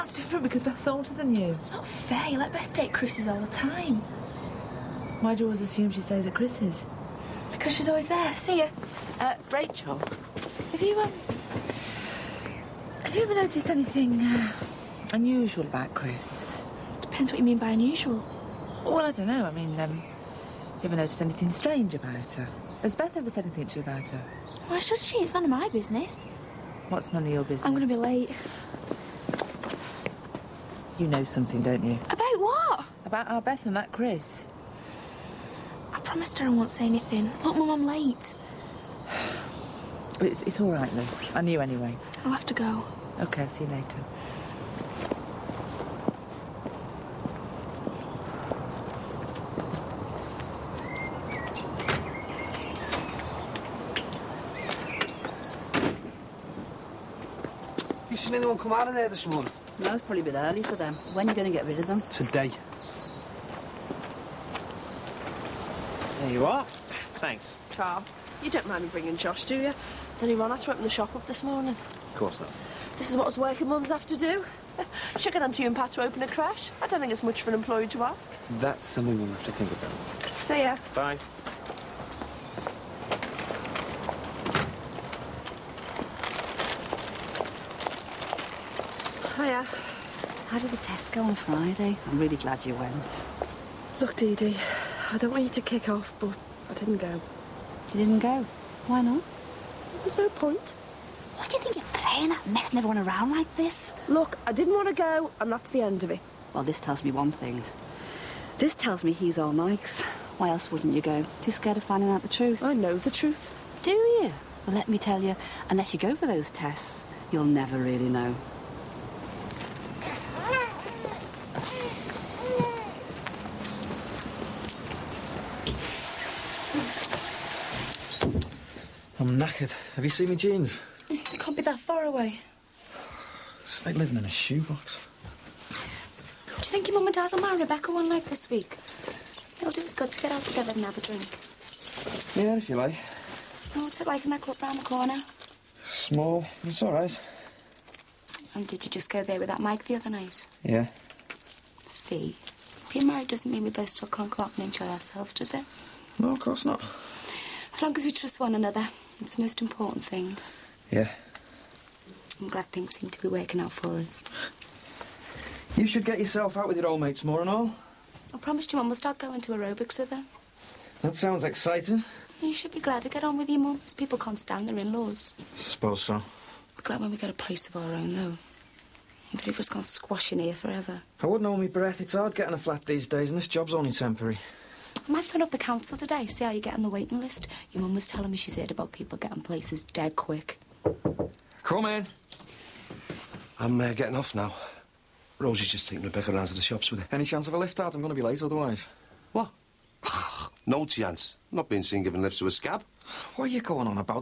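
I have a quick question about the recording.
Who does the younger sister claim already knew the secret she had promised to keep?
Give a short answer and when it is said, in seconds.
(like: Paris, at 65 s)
Lou, at 40 s.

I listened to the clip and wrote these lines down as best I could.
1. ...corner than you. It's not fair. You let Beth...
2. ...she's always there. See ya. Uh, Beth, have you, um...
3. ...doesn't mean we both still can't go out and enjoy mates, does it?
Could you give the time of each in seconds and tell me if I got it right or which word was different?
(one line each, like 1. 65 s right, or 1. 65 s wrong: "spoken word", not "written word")
1. 0 s wrong: "older", not "corner"
2. 7 s wrong: "Rachel", not "Beth"
3. 153 s wrong: "ourselves", not "mates".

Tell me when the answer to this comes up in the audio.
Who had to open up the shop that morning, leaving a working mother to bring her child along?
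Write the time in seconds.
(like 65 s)
70 s.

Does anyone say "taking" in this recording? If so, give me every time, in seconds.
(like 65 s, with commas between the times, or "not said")
195 s.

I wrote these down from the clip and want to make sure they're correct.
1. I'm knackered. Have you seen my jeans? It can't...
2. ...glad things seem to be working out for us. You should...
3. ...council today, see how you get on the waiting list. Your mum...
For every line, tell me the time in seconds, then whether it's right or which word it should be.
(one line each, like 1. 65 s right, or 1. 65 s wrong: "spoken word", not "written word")
1. 129 s right
2. 162 s right
3. 185 s right.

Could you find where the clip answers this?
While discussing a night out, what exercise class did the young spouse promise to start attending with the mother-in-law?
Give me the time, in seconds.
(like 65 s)
169 s.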